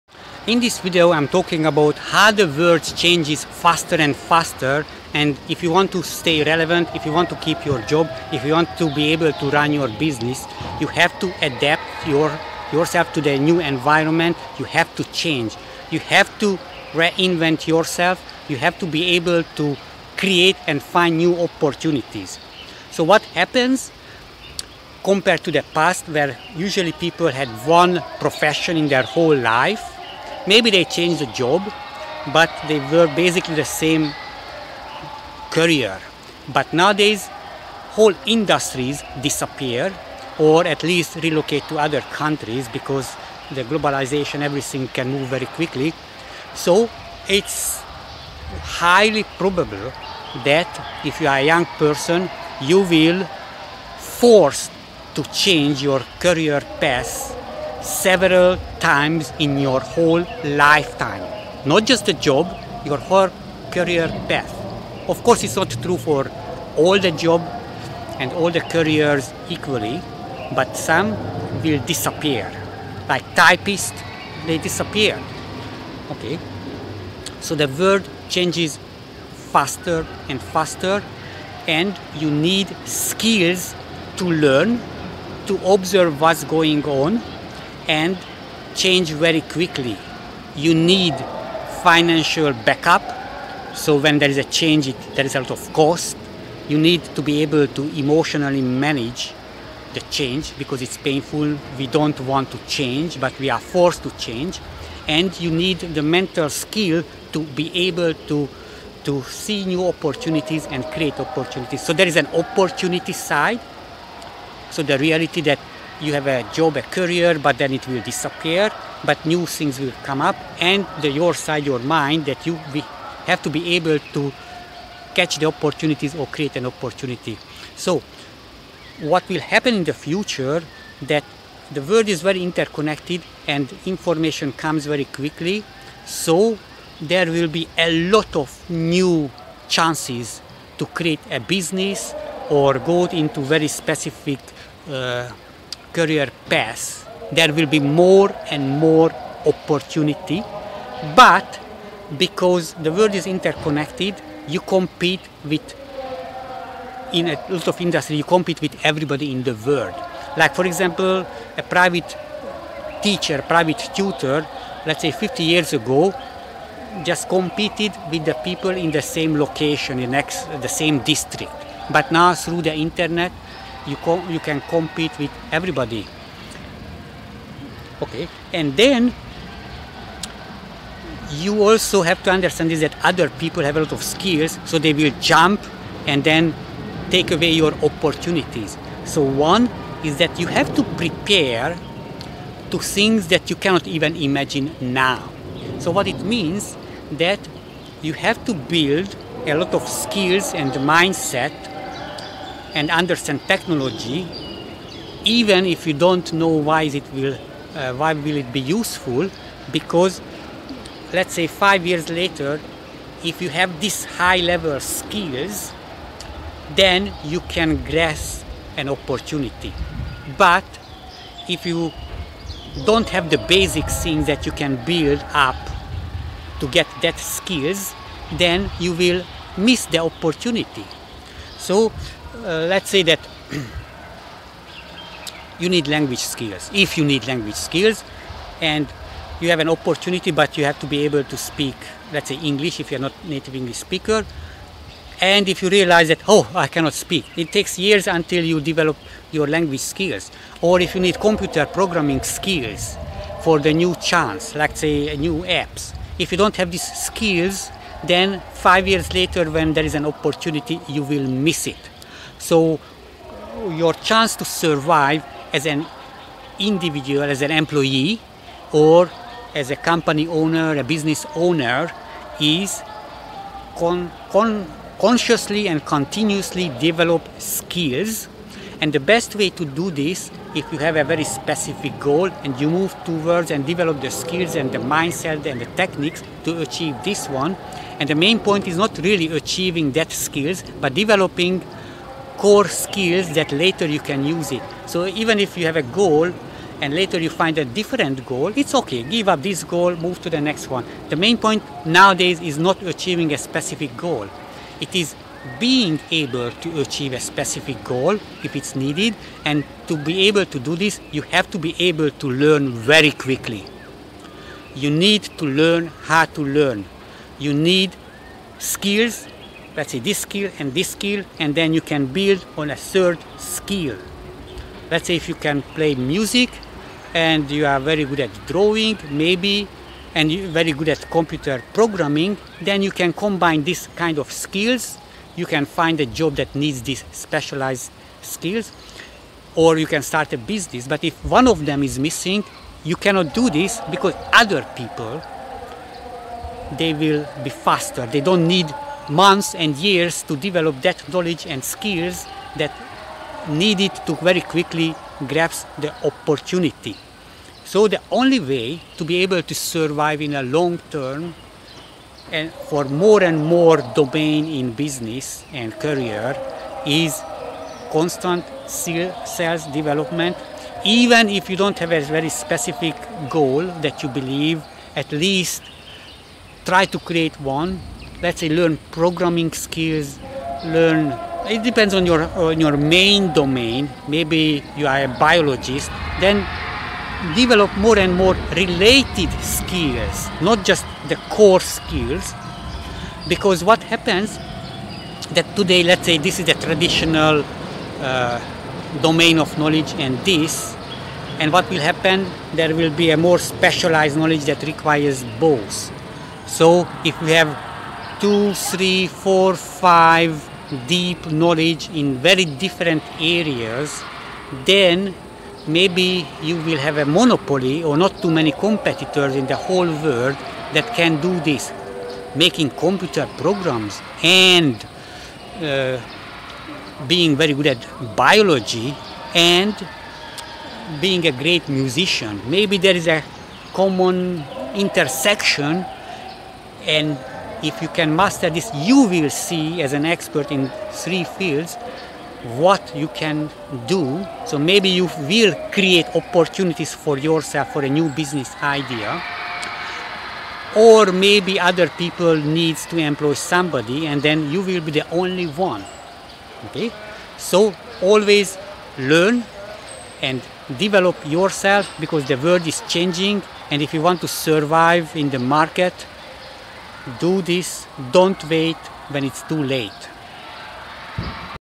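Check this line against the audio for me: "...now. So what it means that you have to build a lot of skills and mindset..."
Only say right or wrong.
right.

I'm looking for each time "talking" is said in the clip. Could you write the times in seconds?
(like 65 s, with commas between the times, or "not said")
1 s.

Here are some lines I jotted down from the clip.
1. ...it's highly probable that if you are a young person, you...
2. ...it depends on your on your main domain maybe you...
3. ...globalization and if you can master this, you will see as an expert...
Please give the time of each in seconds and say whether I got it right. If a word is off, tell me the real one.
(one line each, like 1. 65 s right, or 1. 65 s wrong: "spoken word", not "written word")
1. 47 s right
2. 381 s right
3. 434 s wrong: "intersection", not "globalization".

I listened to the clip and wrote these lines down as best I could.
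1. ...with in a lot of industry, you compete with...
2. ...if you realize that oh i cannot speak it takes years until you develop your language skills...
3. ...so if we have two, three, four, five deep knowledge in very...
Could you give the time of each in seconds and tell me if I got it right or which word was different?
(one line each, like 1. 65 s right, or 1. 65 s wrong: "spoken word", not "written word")
1. 155 s right
2. 245 s right
3. 406 s right.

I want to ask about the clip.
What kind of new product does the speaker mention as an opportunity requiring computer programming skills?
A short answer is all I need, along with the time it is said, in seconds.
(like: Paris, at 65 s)
New apps, at 255 s.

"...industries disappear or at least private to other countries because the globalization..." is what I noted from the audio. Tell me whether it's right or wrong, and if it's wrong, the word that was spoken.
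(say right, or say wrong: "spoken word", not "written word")
wrong: "relocate", not "private".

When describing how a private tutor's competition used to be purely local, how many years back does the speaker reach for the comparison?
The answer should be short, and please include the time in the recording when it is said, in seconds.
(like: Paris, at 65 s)
50, at 165 s.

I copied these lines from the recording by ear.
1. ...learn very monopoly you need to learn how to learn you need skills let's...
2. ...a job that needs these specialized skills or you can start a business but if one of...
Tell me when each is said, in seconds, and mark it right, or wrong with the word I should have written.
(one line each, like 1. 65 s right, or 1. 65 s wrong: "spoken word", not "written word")
1. 312 s wrong: "quickly", not "monopoly"
2. 336 s right.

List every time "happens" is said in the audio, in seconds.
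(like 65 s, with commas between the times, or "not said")
23 s, 129 s, 393 s, 401 s.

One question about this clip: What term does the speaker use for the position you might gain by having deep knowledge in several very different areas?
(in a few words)
Monopoly.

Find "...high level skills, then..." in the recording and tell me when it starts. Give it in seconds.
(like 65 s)
214 s.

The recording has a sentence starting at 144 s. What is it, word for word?
Uh, career path, there will be more and more opportunity.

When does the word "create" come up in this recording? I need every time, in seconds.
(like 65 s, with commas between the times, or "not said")
20 s, 110 s, 126 s, 140 s, 376 s, 445 s.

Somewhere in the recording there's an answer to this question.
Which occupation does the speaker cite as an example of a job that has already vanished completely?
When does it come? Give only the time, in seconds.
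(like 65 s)
73 s.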